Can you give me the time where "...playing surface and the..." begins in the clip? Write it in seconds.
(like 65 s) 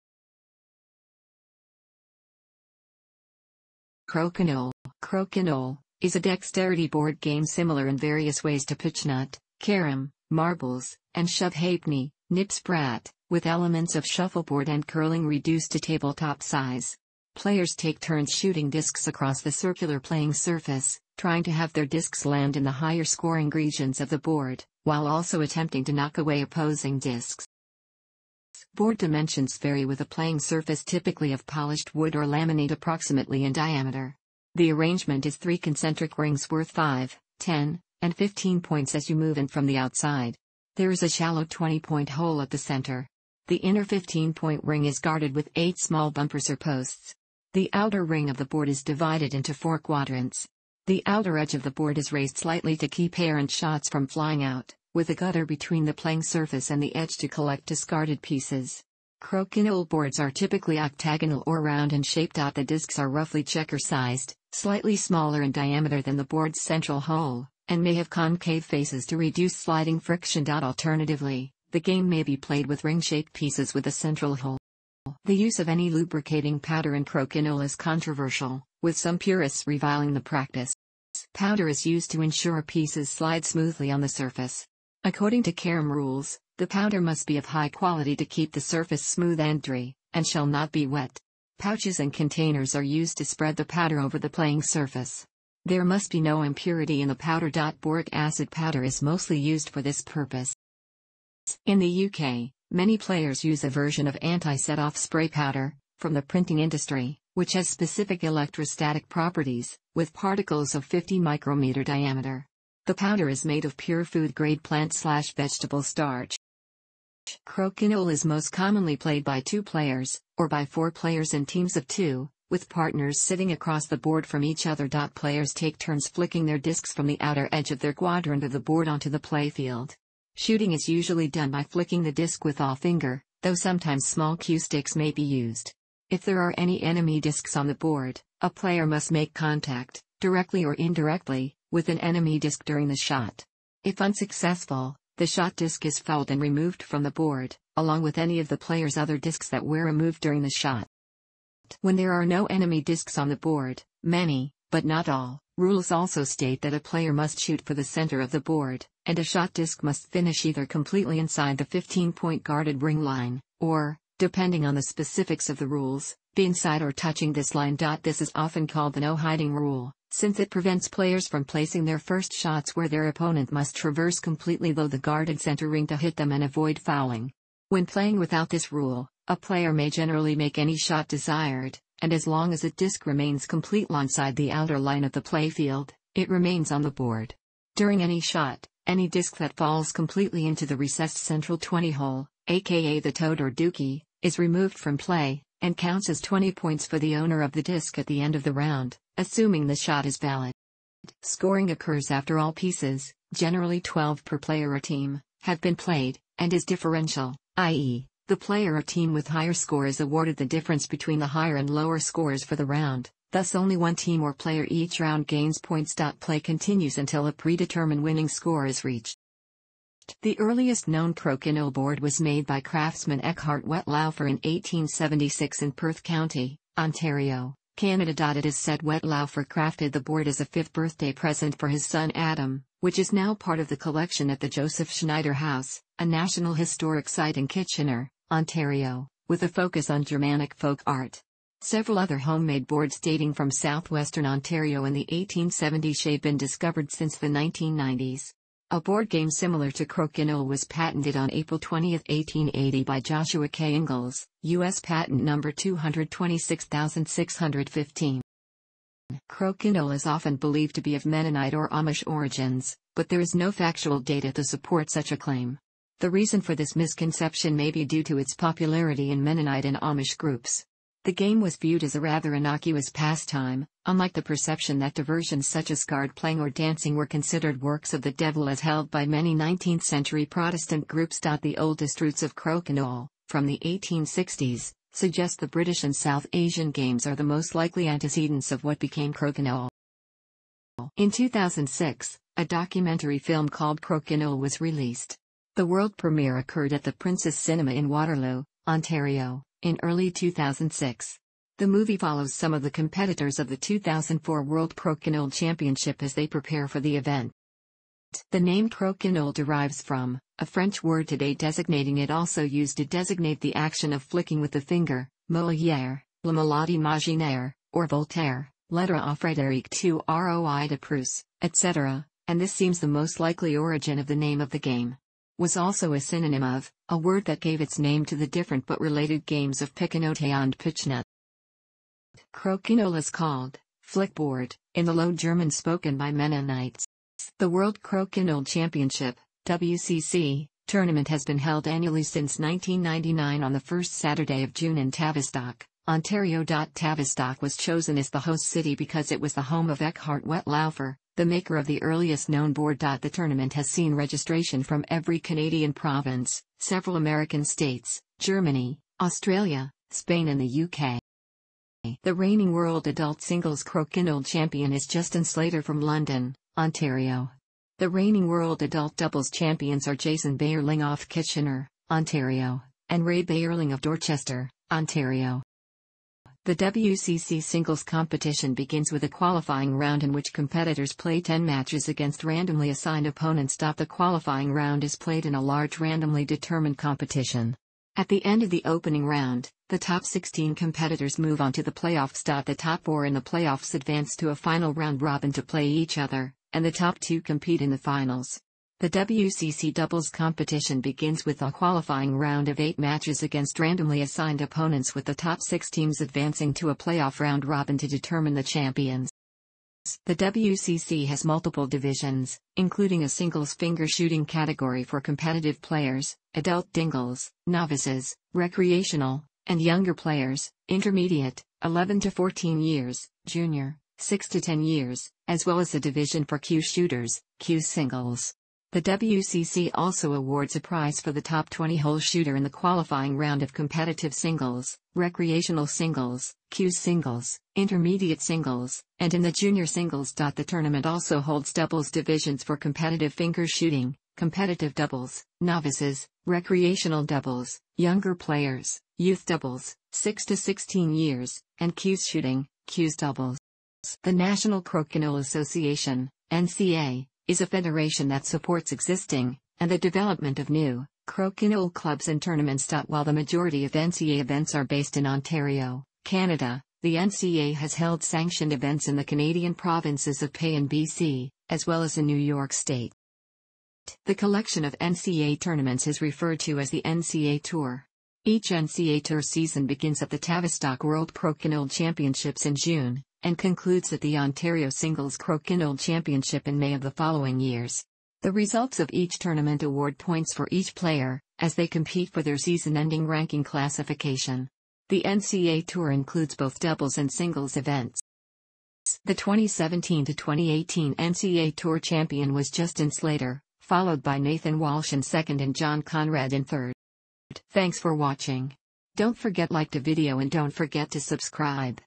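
55 s.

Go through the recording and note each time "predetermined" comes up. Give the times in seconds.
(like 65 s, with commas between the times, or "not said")
217 s.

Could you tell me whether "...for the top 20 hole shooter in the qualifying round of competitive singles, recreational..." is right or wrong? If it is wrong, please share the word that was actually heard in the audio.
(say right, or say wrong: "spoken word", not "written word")
right.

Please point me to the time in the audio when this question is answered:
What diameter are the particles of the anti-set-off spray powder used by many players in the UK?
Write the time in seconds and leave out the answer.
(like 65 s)
110 s.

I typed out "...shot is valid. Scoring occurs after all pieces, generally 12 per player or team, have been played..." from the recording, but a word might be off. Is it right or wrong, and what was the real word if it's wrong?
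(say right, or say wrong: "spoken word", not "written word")
right.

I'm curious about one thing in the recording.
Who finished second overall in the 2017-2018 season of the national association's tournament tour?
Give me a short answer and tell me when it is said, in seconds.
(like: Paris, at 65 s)
Nathan Walsh, at 504 s.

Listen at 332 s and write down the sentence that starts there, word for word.
Crokinole is called, flickboard, in the Low German spoken by Mennonites.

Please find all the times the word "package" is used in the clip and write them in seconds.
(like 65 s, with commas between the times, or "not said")
not said.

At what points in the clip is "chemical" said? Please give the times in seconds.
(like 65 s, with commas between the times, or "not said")
not said.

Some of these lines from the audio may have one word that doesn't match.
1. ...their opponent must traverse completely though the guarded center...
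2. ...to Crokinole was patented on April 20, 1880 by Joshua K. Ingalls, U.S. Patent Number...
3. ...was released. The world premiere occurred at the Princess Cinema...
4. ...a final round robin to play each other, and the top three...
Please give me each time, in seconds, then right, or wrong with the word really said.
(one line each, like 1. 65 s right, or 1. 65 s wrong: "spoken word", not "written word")
1. 172 s right
2. 249 s right
3. 294 s right
4. 394 s wrong: "two", not "three".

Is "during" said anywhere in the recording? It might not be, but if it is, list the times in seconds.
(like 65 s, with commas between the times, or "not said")
142 s, 150 s, 187 s.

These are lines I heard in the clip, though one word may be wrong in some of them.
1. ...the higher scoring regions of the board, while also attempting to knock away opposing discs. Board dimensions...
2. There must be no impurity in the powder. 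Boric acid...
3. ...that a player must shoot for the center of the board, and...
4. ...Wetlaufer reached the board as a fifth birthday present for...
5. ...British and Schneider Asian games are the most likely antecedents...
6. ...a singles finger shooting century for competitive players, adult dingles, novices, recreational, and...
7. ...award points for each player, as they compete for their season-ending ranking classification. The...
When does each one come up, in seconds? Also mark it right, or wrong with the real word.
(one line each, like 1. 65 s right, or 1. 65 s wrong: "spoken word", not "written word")
1. 22 s right
2. 95 s right
3. 156 s right
4. 228 s wrong: "crafted", not "reached"
5. 285 s wrong: "South", not "Schneider"
6. 413 s wrong: "category", not "century"
7. 489 s right.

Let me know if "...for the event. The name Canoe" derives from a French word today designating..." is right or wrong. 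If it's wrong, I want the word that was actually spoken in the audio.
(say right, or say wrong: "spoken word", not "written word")
right.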